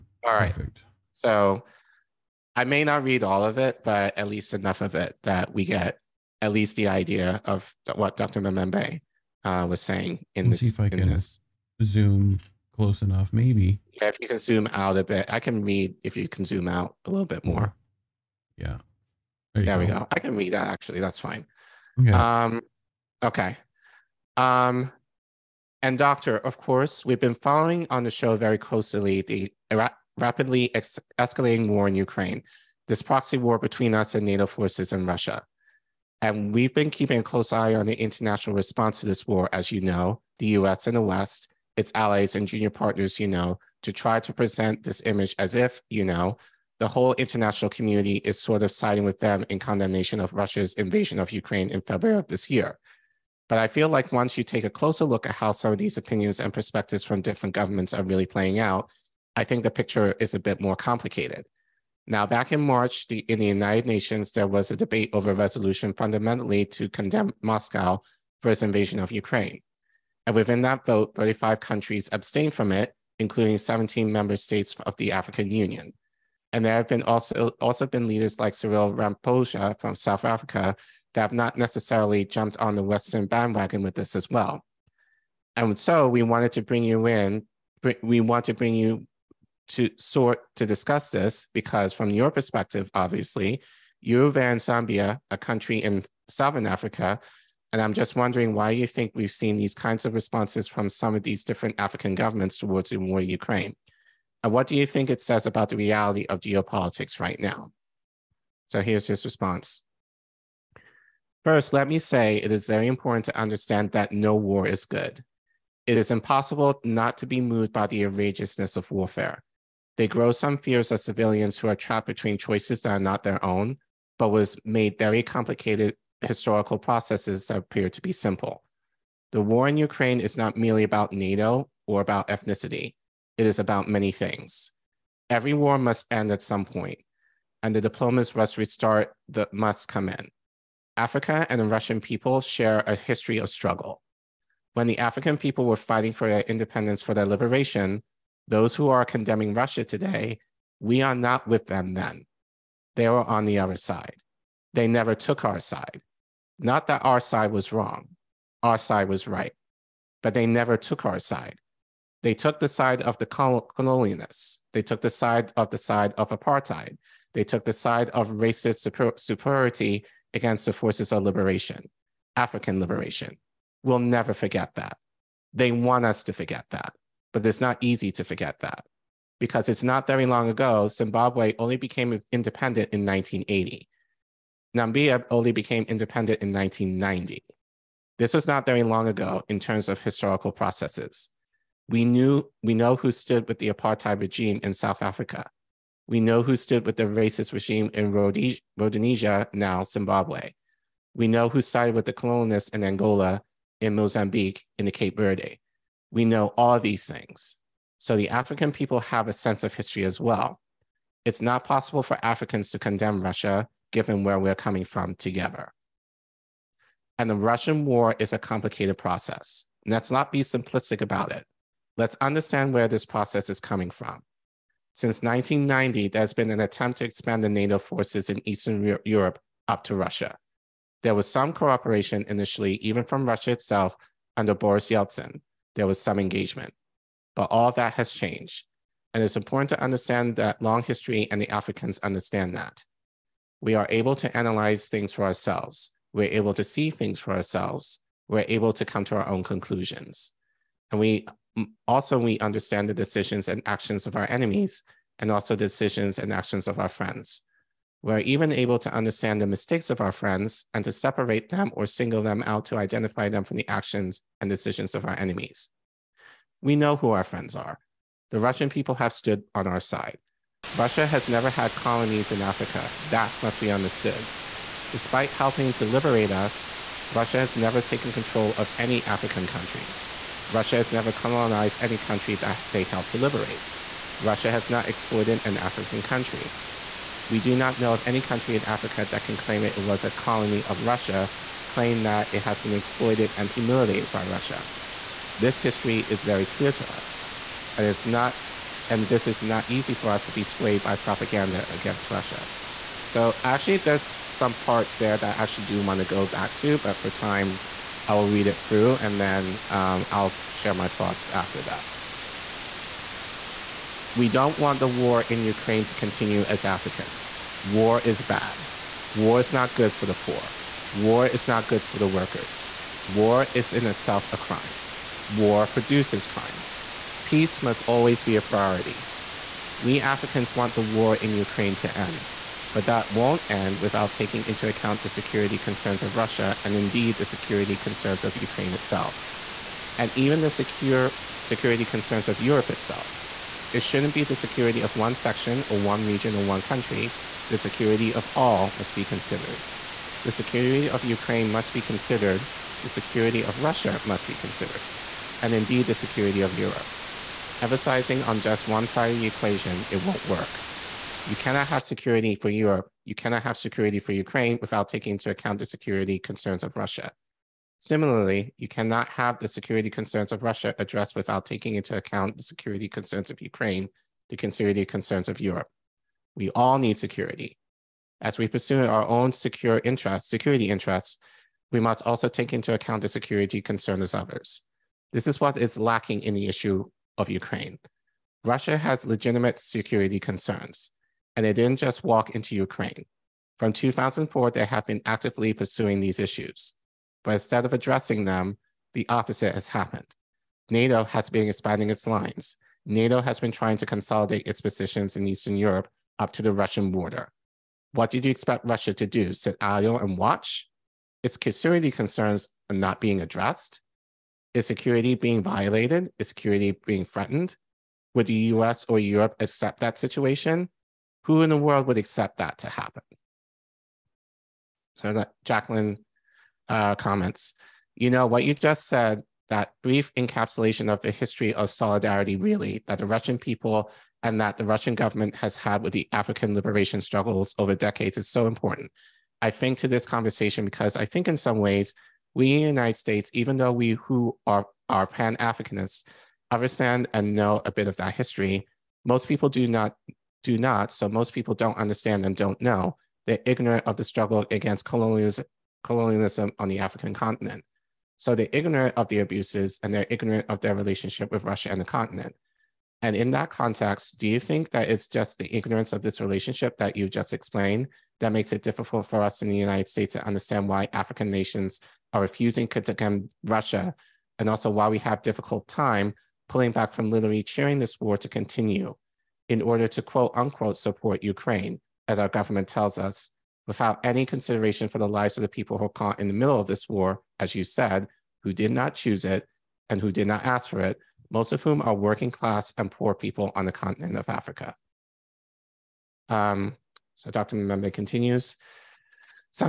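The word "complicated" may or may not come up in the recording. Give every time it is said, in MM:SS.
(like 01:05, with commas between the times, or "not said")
01:00, 02:05, 03:38.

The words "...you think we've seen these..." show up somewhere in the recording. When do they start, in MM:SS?
01:38.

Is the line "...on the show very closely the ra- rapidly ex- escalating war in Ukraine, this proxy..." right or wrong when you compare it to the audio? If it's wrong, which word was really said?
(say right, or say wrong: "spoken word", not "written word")
right.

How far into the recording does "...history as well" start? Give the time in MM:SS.
03:29.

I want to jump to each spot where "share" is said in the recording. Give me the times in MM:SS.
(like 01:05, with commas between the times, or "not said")
02:22, 05:10.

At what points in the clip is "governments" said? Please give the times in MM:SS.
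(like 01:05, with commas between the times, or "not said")
00:57, 01:42, 07:14, 08:02.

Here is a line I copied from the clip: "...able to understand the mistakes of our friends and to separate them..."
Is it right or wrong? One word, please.
right.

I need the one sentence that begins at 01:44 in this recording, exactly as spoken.
And uh, what do you think it says about the reality of geopolitics right now?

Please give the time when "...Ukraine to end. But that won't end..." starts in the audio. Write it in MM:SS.
05:31.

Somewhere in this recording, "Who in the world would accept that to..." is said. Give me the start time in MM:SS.
07:01.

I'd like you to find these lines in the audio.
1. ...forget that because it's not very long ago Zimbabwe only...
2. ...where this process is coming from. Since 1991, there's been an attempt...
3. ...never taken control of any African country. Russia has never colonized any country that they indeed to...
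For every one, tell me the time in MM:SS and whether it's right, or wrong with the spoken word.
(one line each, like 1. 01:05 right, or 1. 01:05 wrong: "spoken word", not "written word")
1. 02:58 right
2. 03:42 wrong: "1990", not "1991"
3. 04:37 wrong: "helped", not "indeed".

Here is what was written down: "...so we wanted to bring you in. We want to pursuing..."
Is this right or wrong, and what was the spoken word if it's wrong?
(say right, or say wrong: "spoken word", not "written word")
wrong: "bring", not "pursuing".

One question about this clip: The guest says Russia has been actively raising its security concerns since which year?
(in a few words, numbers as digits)
2004.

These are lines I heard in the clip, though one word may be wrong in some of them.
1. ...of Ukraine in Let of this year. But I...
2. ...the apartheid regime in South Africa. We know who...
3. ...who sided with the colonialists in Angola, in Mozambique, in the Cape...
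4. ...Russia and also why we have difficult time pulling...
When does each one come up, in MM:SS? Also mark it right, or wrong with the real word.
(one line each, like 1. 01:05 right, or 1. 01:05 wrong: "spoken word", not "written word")
1. 00:51 wrong: "February", not "Let"
2. 03:13 right
3. 03:21 right
4. 07:53 right.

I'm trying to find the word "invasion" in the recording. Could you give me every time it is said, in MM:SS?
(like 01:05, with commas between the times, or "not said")
00:50, 01:08.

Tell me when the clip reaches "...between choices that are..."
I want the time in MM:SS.
02:02.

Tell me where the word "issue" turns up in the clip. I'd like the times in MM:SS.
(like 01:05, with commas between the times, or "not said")
06:26, 06:36.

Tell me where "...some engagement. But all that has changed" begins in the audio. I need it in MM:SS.
03:55.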